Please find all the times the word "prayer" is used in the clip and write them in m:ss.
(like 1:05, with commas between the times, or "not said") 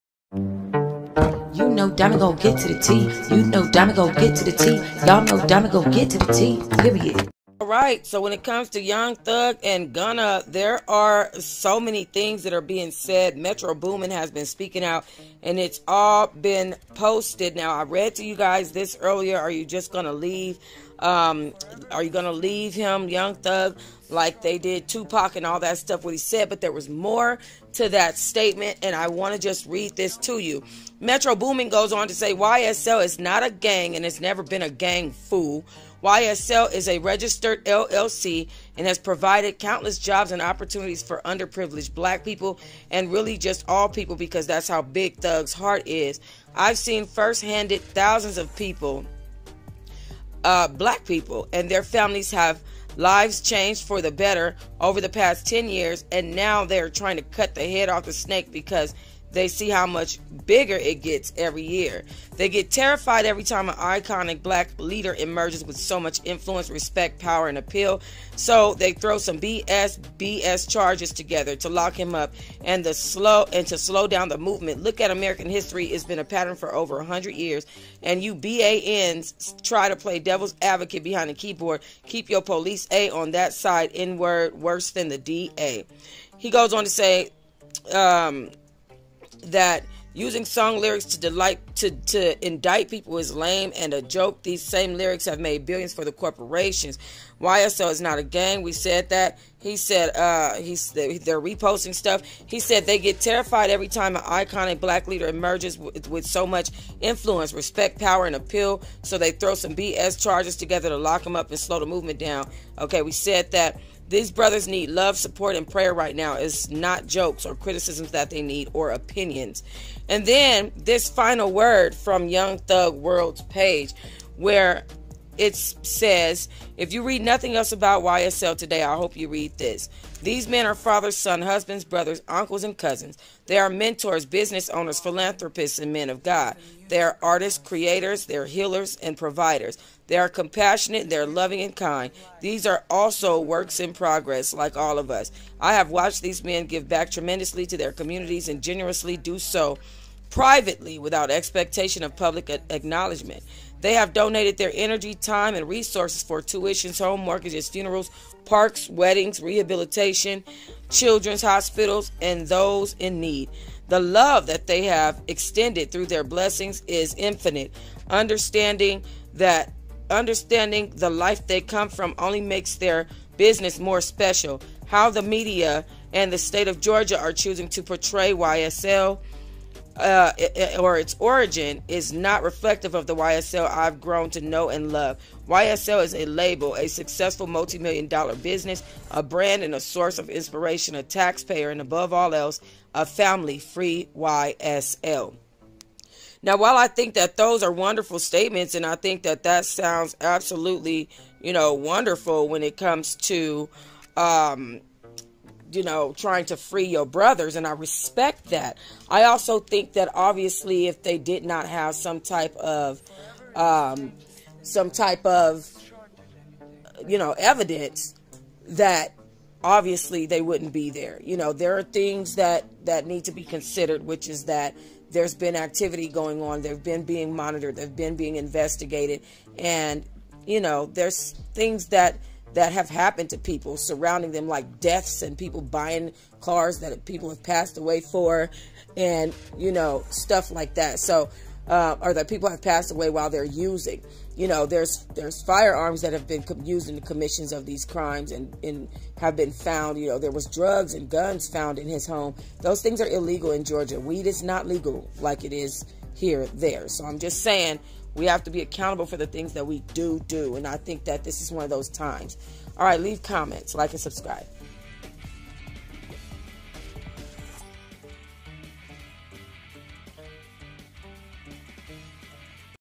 1:55.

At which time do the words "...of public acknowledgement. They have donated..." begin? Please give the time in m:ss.
2:32.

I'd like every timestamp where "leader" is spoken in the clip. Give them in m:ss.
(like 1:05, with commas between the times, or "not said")
1:04, 1:45.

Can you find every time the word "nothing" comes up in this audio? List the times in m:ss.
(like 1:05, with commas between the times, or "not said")
2:07.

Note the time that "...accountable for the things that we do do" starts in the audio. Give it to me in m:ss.
4:18.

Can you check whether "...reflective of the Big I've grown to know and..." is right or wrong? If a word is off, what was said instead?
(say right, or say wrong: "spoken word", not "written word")
wrong: "YSL", not "Big".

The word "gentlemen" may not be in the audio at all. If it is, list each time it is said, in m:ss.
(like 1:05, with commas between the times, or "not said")
not said.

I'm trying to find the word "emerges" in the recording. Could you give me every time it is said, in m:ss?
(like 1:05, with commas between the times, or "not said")
1:05, 1:45.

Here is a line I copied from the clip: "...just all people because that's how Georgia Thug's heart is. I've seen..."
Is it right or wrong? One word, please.
wrong.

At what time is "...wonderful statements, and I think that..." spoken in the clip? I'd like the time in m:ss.
3:17.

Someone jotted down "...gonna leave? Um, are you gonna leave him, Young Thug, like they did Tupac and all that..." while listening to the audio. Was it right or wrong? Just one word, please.
right.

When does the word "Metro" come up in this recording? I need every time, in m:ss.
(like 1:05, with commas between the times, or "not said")
0:13, 0:30.